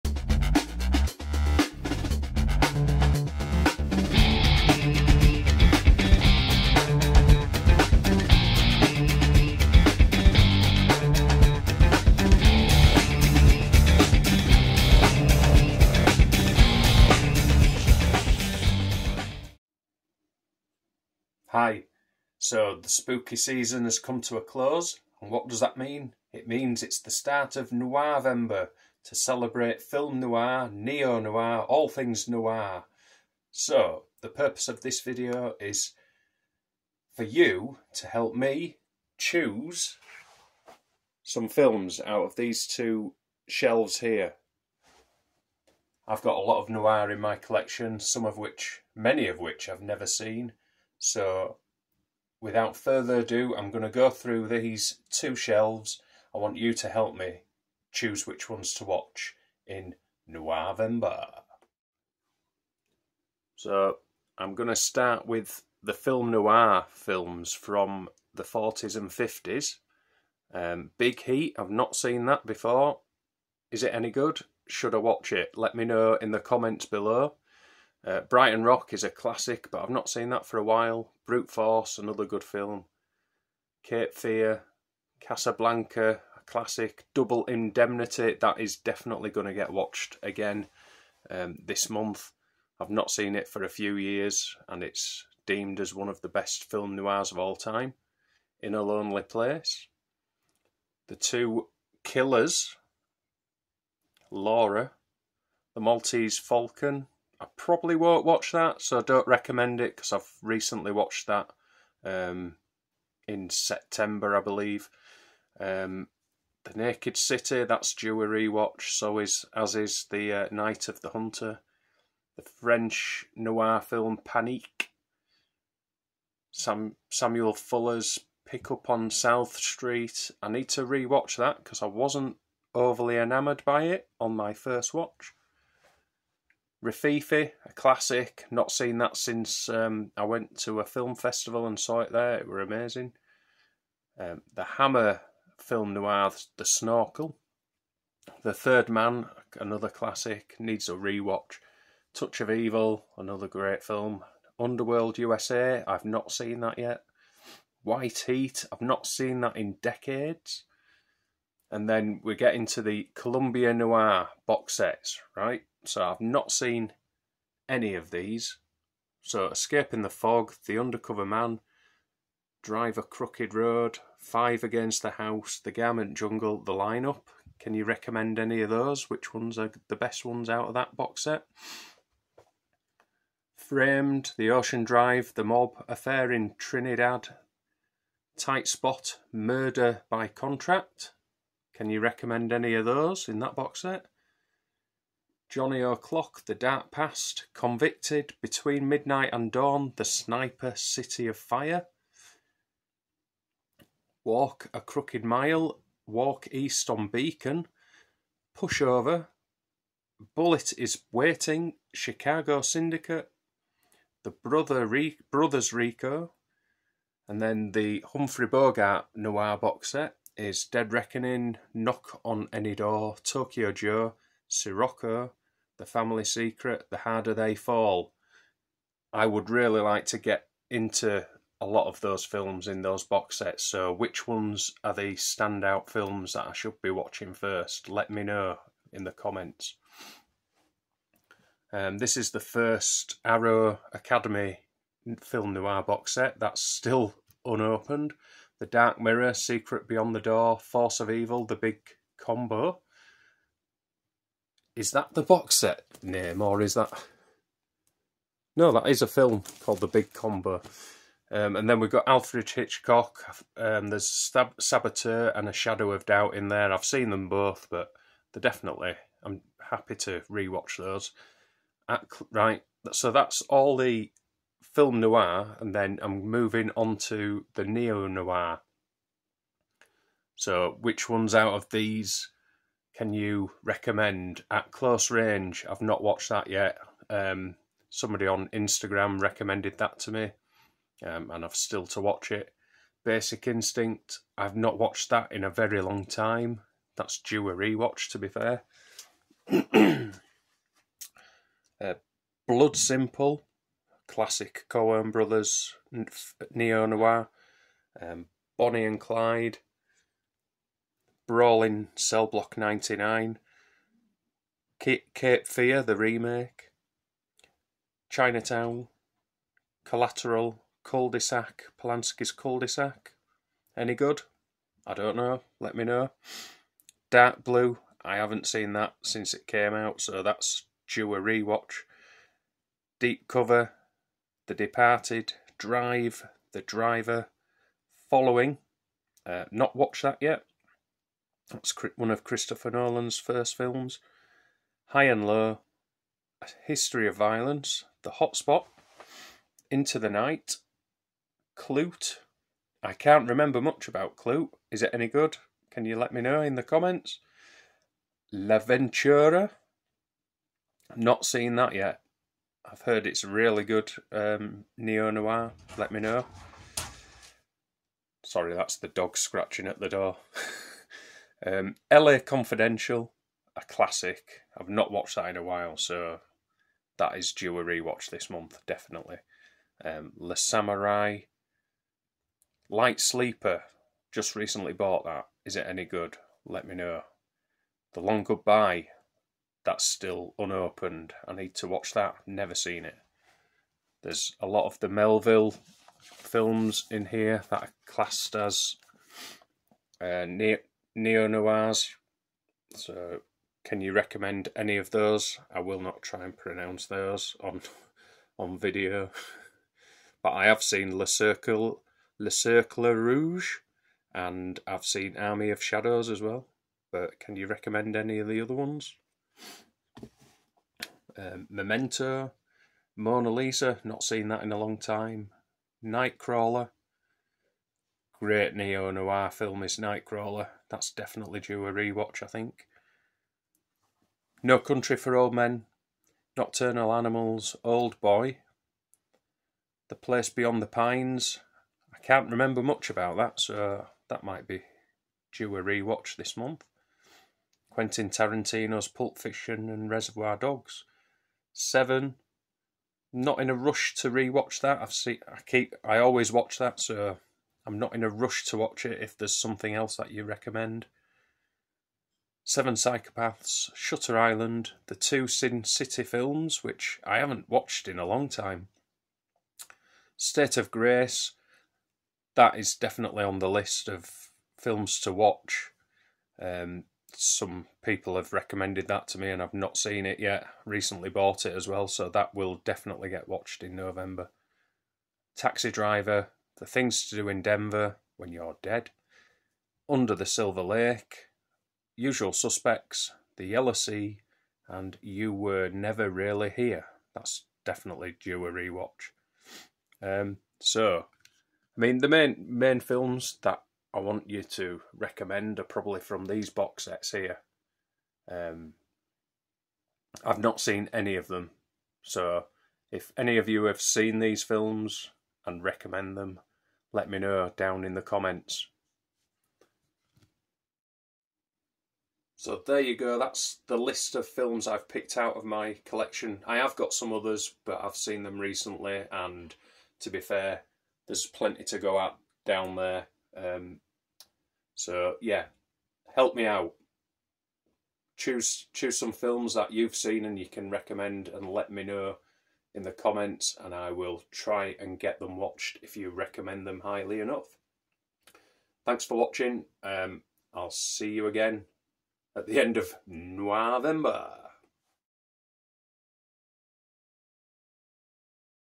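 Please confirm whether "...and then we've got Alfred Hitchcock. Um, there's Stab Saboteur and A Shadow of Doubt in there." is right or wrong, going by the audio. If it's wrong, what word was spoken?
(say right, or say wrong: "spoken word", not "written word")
right.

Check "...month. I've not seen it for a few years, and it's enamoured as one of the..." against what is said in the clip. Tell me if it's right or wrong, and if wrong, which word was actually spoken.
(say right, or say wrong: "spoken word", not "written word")
wrong: "deemed", not "enamoured".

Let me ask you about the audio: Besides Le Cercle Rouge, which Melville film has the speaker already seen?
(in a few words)
Army of Shadows.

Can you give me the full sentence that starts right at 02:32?
Touch of Evil, another great film.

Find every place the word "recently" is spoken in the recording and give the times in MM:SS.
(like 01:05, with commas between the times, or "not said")
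01:50, 06:24, 08:00, 08:48.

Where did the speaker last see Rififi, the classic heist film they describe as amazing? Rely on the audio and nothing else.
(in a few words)
A film festival.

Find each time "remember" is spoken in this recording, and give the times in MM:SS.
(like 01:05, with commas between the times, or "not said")
05:53, 07:22.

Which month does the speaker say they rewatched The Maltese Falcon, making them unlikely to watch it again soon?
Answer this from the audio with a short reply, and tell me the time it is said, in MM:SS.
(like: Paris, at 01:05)
September, at 01:53.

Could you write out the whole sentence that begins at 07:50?
State of Grace, that is definitely on the list of films to watch.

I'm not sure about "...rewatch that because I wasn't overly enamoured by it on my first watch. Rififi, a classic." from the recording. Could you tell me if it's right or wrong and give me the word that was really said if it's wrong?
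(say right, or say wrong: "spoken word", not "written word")
right.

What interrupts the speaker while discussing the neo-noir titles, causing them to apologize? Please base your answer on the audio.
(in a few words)
The dog.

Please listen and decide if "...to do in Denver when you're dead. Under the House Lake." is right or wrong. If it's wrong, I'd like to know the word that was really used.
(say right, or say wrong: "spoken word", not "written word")
wrong: "Silver", not "House".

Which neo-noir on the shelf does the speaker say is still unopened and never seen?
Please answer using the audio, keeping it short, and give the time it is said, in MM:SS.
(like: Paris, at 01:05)
The Long Goodbye, at 06:27.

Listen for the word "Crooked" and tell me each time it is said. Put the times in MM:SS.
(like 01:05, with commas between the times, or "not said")
02:53, 03:24.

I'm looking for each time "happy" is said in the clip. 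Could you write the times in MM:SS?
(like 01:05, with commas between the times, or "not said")
04:29.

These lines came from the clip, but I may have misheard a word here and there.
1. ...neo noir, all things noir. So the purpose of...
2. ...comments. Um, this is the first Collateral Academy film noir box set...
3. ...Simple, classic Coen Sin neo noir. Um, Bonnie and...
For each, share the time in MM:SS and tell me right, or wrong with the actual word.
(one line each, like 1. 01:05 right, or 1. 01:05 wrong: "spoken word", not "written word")
1. 00:30 right
2. 03:59 wrong: "Arrow", not "Collateral"
3. 05:02 wrong: "Brothers", not "Sin".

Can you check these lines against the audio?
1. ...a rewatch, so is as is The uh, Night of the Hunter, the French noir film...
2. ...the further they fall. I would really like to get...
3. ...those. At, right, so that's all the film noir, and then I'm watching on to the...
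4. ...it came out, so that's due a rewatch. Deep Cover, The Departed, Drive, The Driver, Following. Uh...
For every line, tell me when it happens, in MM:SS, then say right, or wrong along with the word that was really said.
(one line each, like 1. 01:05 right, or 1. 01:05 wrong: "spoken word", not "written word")
1. 01:58 right
2. 03:46 wrong: "harder", not "further"
3. 04:30 wrong: "moving", not "watching"
4. 05:29 right.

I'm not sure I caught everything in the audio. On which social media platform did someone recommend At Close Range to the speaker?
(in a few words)
Instagram.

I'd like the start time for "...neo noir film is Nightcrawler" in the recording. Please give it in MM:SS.
07:08.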